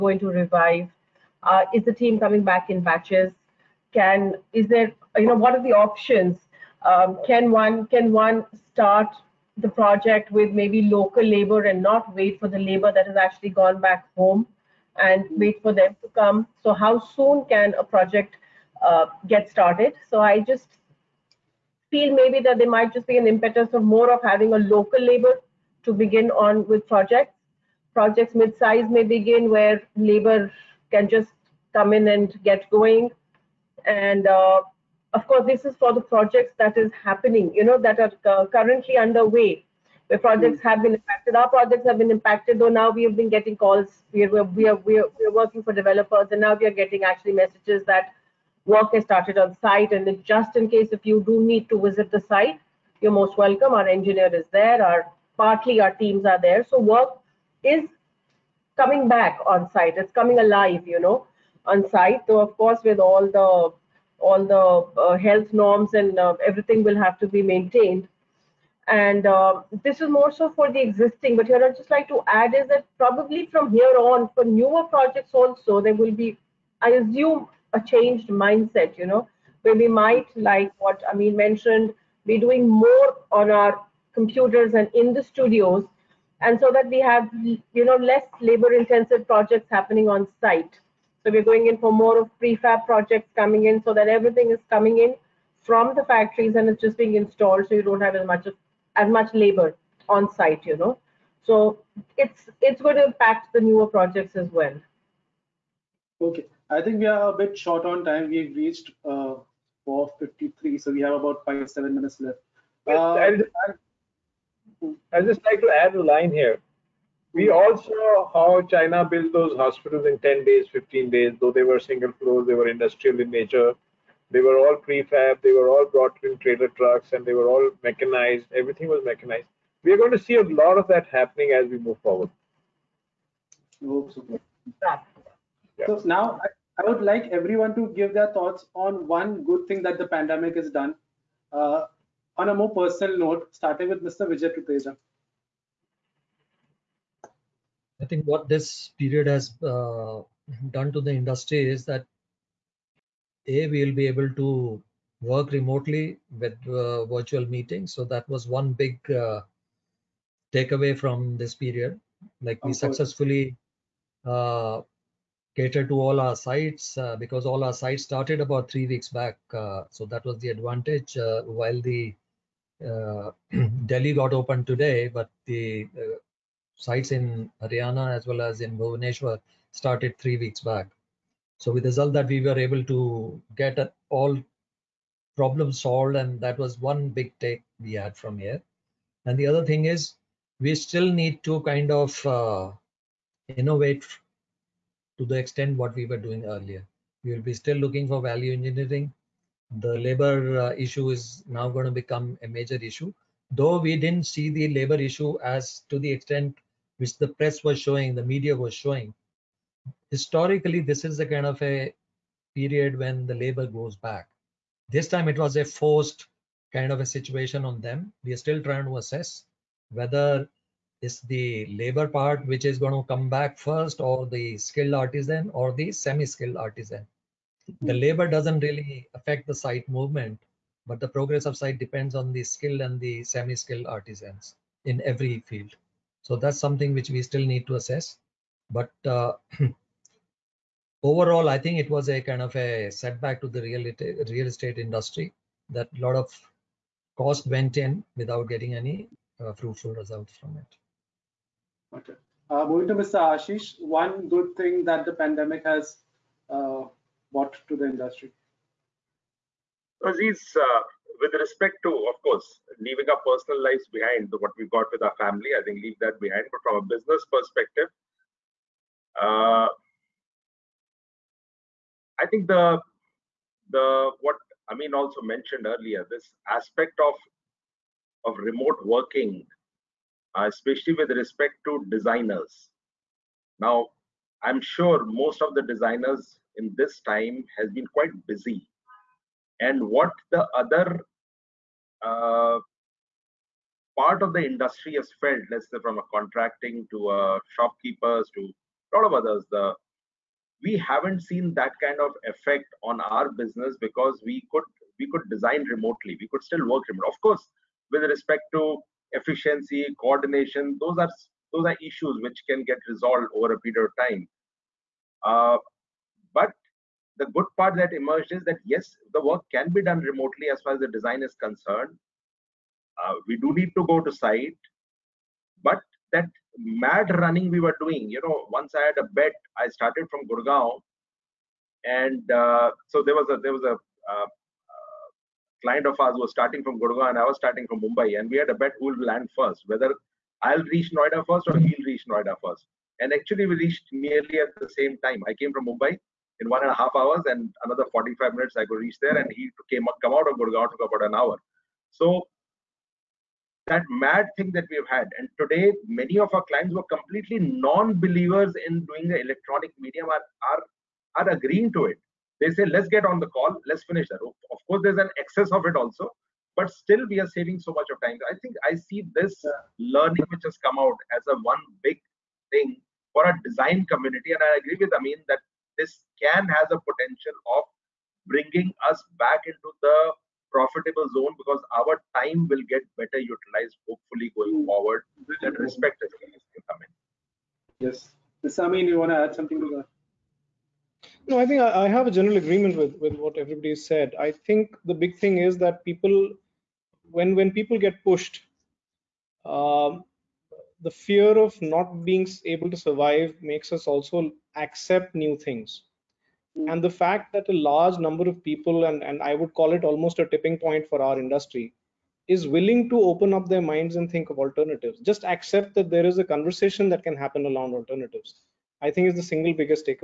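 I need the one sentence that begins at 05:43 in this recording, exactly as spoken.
And actually, we reached nearly at the same time.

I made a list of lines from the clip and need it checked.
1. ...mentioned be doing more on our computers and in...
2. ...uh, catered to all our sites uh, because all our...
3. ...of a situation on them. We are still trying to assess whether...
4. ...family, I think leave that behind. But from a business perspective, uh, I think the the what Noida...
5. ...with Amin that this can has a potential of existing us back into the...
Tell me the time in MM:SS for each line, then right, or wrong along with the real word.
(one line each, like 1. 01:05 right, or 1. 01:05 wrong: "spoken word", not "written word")
1. 01:21 right
2. 02:44 right
3. 03:36 right
4. 04:25 wrong: "Amin", not "Noida"
5. 06:14 wrong: "bringing", not "existing".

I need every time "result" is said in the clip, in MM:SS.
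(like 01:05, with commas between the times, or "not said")
03:01, 04:09.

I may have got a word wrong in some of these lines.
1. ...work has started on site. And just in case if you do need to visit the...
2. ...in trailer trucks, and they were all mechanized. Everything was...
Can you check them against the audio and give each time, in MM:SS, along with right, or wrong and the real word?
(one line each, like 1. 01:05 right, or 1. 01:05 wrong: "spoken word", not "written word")
1. 00:48 right
2. 02:06 right.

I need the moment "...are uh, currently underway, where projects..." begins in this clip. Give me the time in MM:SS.
00:37.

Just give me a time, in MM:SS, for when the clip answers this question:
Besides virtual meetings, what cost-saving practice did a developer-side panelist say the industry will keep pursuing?
03:18.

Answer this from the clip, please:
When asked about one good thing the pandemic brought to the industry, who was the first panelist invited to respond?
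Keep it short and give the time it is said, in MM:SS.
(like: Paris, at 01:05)
Vijay Tuteja, at 02:24.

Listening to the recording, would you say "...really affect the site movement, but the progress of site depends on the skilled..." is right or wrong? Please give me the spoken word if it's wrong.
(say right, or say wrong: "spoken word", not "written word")
right.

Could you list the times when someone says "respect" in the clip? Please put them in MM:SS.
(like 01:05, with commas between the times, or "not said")
04:21, 04:41, 05:08, 06:25.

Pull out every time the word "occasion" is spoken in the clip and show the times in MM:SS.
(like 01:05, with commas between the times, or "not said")
not said.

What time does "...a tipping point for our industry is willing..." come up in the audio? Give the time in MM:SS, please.
06:50.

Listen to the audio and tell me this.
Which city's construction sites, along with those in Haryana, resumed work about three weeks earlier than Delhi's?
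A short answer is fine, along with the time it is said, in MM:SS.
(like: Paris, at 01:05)
Bhubaneswar, at 02:58.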